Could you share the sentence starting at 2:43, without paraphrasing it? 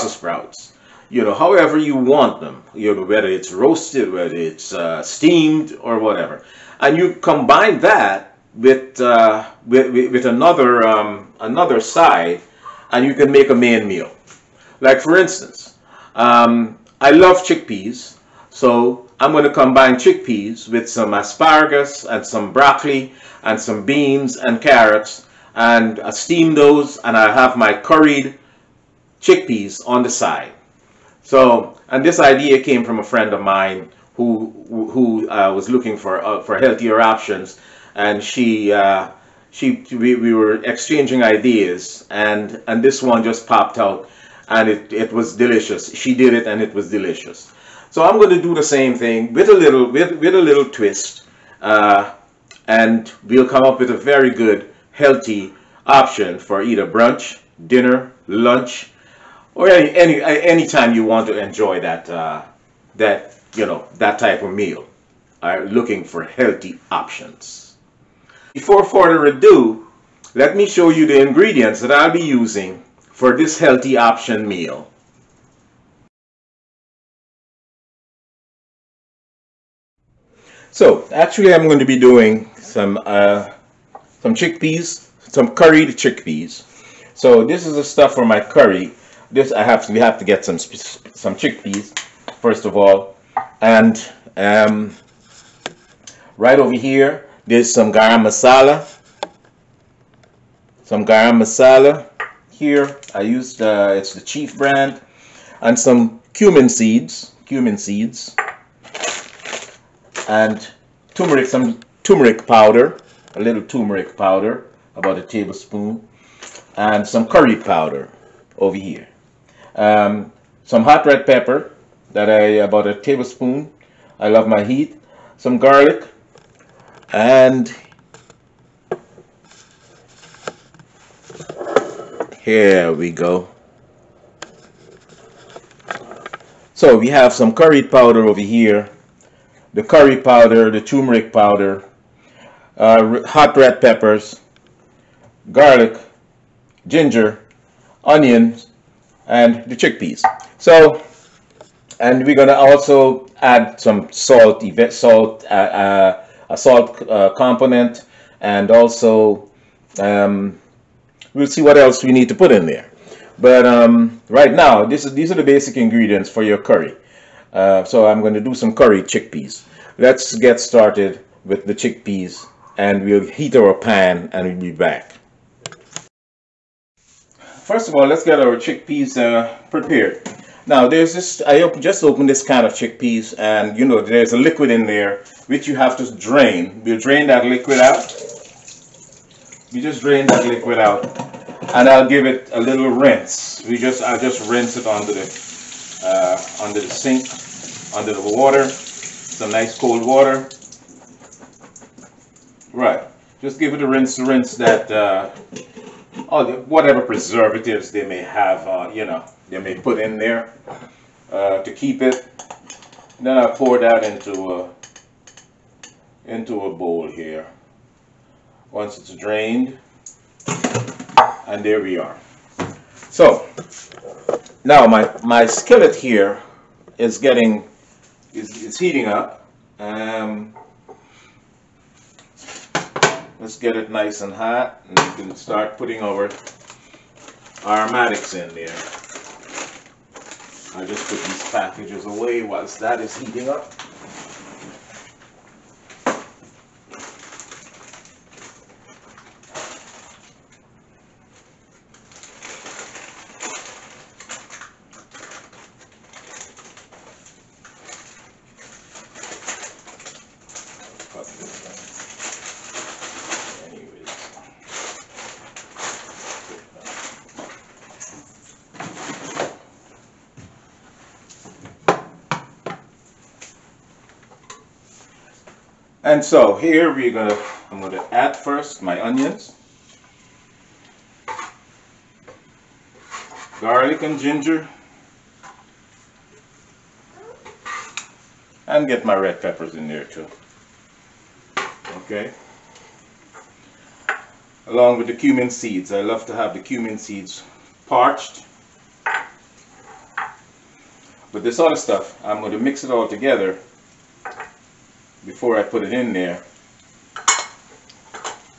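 But um, right now, this is, these are the basic ingredients for your curry.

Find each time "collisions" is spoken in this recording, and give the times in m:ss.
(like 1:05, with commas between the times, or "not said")
not said.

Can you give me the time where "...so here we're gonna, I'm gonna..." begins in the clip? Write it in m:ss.
4:36.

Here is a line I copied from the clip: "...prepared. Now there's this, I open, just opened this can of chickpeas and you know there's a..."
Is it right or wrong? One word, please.
right.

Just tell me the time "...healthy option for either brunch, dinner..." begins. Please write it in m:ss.
0:54.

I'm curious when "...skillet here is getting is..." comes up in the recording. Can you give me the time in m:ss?
3:45.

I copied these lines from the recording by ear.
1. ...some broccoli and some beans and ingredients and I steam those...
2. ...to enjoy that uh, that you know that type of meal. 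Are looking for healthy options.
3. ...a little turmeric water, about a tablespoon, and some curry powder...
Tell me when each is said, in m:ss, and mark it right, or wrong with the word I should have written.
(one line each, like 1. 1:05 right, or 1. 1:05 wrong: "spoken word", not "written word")
1. 0:22 wrong: "carrots", not "ingredients"
2. 1:01 right
3. 1:53 wrong: "powder", not "water".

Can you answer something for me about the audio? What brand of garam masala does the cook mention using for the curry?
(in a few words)
Chief.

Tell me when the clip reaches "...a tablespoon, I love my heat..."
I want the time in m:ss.
2:02.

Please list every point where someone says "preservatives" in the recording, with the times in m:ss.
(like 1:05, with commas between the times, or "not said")
3:27.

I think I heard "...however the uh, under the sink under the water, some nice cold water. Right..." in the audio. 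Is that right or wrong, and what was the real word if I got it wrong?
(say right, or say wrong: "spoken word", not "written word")
wrong: "under", not "however".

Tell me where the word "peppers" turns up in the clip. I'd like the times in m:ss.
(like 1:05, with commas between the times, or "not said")
2:01, 2:23, 4:49.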